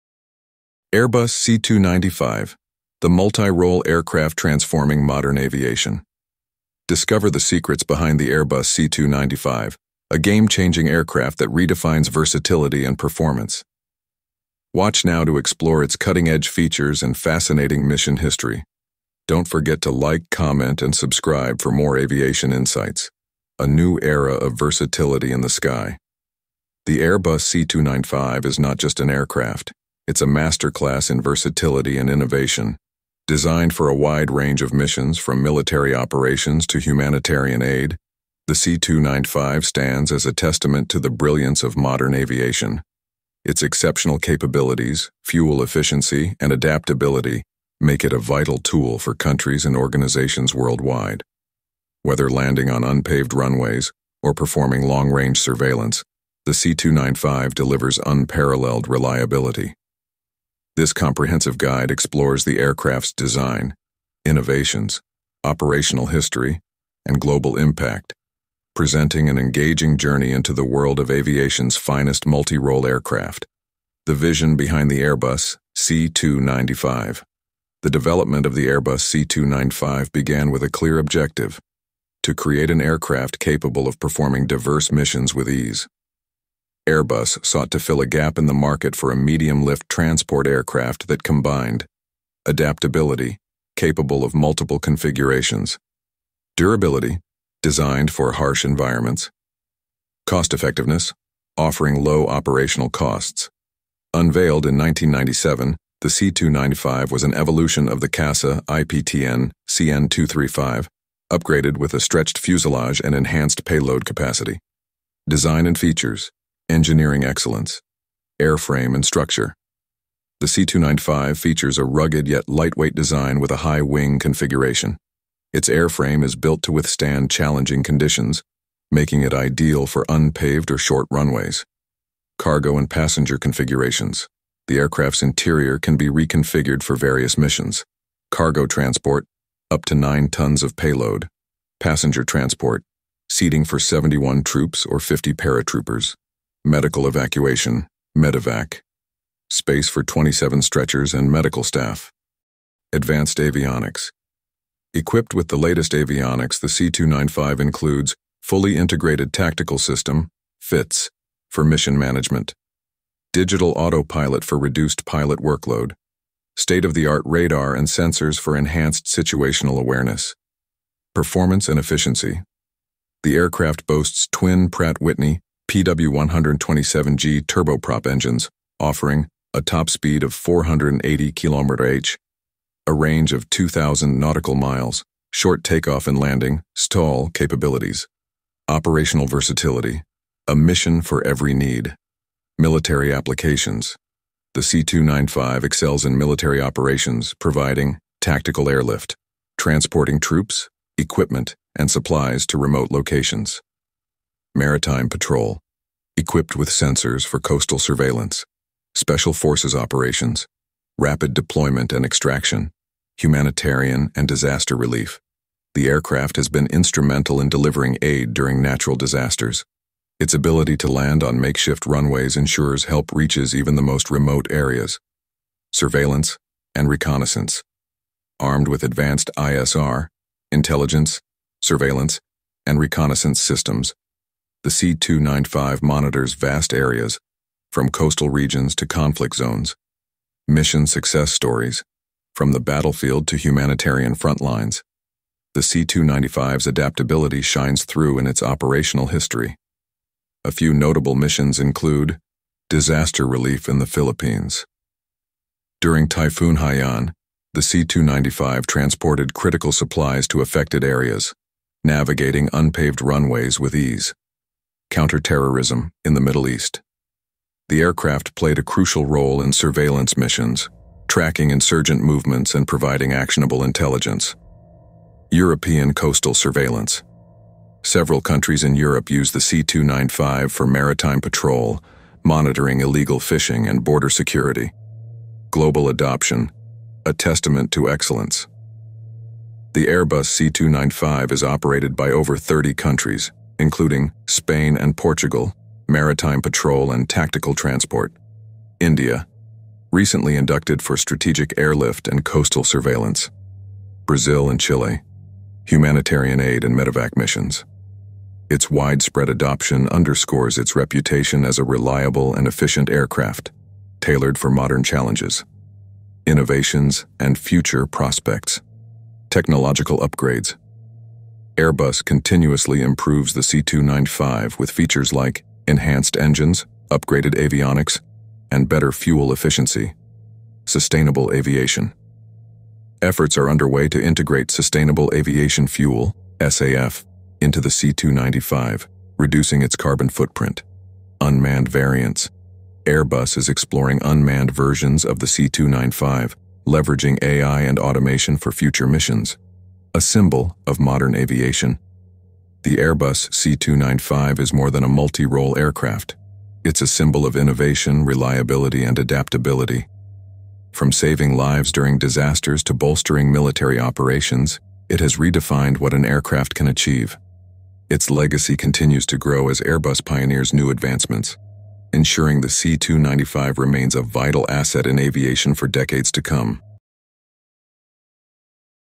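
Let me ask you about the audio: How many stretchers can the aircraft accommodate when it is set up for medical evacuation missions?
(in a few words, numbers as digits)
27.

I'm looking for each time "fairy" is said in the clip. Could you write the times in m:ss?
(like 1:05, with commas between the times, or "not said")
not said.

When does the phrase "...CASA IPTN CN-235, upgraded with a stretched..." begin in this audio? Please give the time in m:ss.
1:48.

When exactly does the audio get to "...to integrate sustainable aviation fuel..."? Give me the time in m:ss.
5:33.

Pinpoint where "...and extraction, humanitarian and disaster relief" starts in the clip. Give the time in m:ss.
3:31.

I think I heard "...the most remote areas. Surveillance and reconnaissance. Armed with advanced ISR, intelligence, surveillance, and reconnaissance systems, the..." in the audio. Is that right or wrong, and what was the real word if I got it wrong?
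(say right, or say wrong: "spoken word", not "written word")
right.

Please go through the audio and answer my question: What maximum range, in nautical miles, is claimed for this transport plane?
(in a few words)
2,000 nautical miles.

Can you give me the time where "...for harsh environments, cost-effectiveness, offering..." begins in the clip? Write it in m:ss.
1:38.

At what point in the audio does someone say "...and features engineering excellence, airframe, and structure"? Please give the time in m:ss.
1:55.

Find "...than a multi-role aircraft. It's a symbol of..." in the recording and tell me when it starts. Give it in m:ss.
5:54.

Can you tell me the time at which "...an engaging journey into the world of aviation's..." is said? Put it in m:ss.
1:09.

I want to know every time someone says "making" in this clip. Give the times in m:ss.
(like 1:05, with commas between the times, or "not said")
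2:08.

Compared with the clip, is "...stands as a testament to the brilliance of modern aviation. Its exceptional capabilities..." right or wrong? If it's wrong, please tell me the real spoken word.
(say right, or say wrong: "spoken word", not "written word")
right.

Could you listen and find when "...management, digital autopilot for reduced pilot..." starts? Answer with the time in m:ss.
2:41.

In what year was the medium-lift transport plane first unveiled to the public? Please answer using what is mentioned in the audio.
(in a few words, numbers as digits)
1997.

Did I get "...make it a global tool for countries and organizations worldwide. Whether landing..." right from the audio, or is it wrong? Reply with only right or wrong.
wrong.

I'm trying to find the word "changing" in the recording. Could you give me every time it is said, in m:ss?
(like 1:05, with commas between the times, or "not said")
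0:10.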